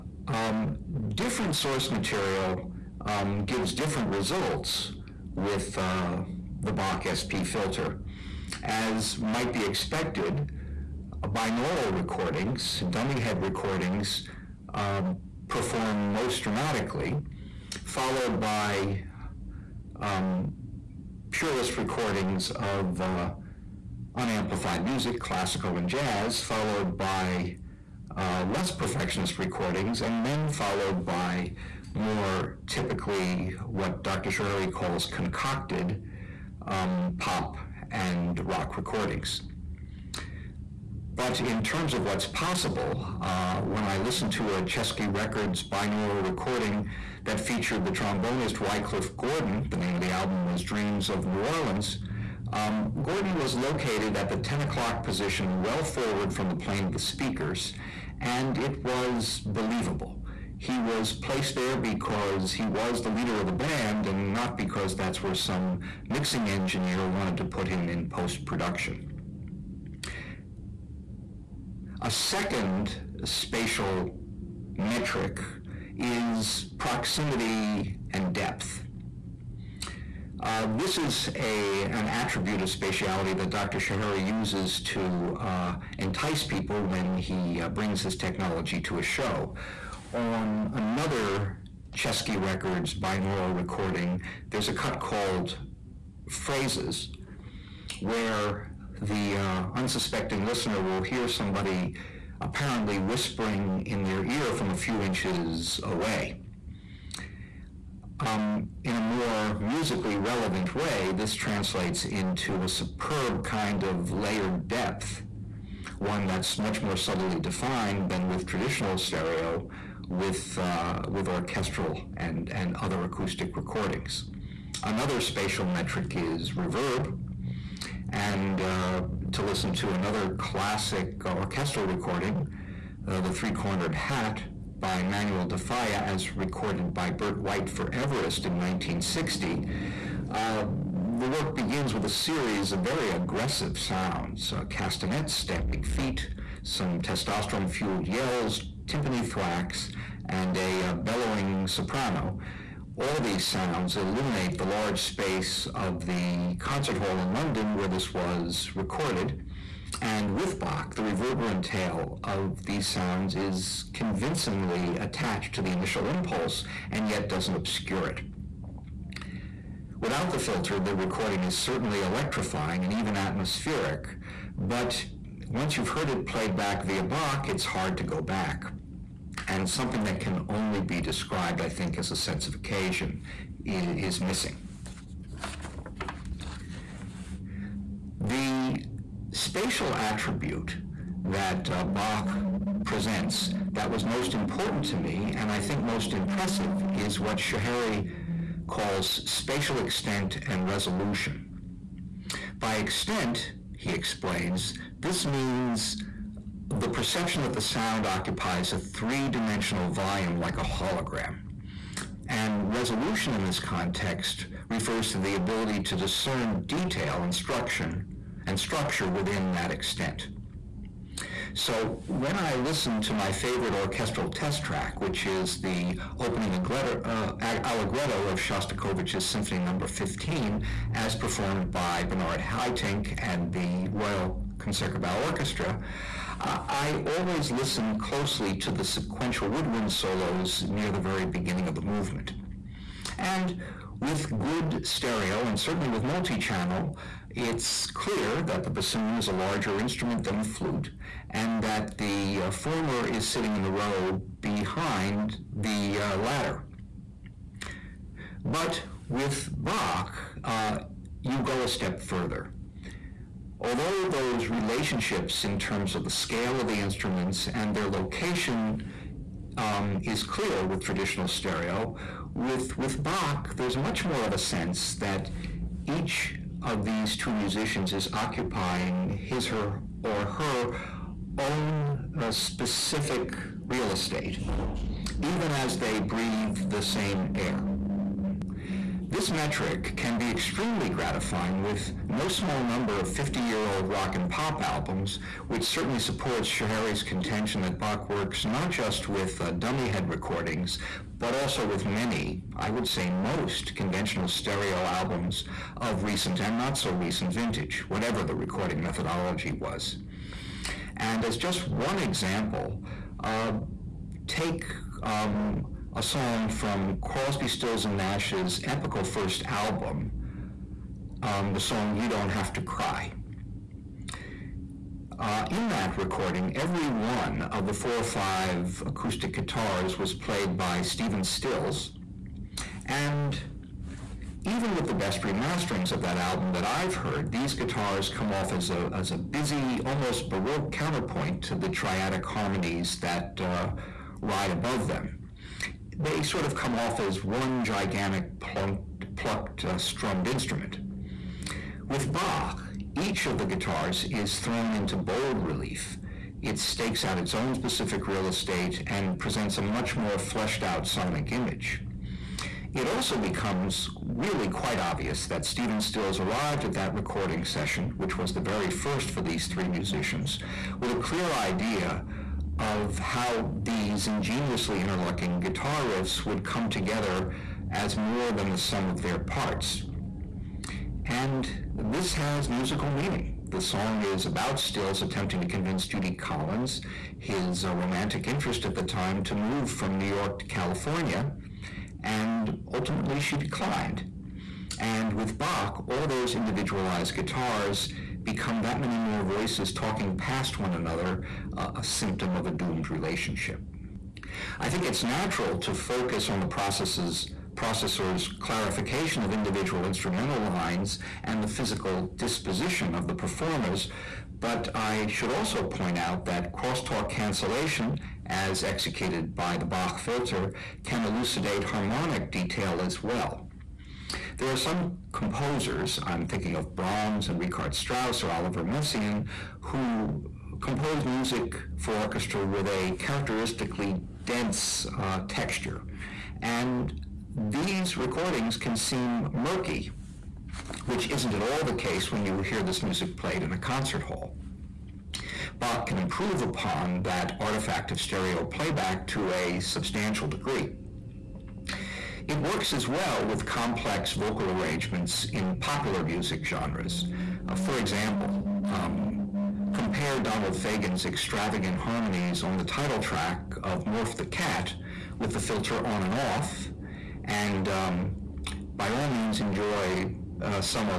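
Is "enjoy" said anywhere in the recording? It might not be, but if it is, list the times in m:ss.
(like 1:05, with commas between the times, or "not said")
7:49.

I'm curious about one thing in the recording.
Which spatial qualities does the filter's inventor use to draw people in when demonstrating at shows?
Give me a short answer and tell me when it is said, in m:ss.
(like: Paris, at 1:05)
proximity and depth, at 1:16.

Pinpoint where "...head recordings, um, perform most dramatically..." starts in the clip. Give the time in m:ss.
0:13.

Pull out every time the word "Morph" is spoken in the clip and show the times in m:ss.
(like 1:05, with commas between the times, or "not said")
7:43.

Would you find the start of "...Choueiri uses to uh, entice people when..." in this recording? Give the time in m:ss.
1:23.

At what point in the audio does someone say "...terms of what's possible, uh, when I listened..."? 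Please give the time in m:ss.
0:41.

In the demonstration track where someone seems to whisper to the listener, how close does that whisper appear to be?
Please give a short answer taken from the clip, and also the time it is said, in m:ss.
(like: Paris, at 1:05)
a few inches, at 1:44.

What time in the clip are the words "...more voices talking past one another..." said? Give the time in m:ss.
6:38.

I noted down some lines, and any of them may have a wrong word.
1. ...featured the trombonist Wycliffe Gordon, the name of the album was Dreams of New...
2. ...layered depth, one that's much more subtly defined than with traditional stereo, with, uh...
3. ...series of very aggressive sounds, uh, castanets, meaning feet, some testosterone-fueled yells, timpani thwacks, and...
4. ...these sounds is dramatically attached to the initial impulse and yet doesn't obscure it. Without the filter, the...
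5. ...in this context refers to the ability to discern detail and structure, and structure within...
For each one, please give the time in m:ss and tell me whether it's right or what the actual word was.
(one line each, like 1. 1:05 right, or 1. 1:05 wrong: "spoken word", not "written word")
1. 0:47 right
2. 1:54 right
3. 2:22 wrong: "stamping", not "meaning"
4. 2:42 wrong: "convincingly", not "dramatically"
5. 3:33 right.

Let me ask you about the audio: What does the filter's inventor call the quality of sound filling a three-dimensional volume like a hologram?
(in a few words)
spatial extent and resolution.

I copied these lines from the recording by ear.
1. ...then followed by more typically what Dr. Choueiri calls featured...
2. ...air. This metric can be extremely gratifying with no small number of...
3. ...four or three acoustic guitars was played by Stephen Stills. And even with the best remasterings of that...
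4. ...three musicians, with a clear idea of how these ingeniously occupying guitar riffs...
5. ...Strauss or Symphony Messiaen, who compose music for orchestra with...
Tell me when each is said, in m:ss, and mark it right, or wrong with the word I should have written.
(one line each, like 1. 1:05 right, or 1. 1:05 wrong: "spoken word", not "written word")
1. 0:30 wrong: "concocted", not "featured"
2. 4:47 right
3. 5:27 wrong: "five", not "three"
4. 6:09 wrong: "interlocking", not "occupying"
5. 7:07 wrong: "Oliver", not "Symphony".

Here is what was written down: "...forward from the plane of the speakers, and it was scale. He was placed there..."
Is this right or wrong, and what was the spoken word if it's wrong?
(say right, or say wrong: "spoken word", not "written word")
wrong: "believable", not "scale".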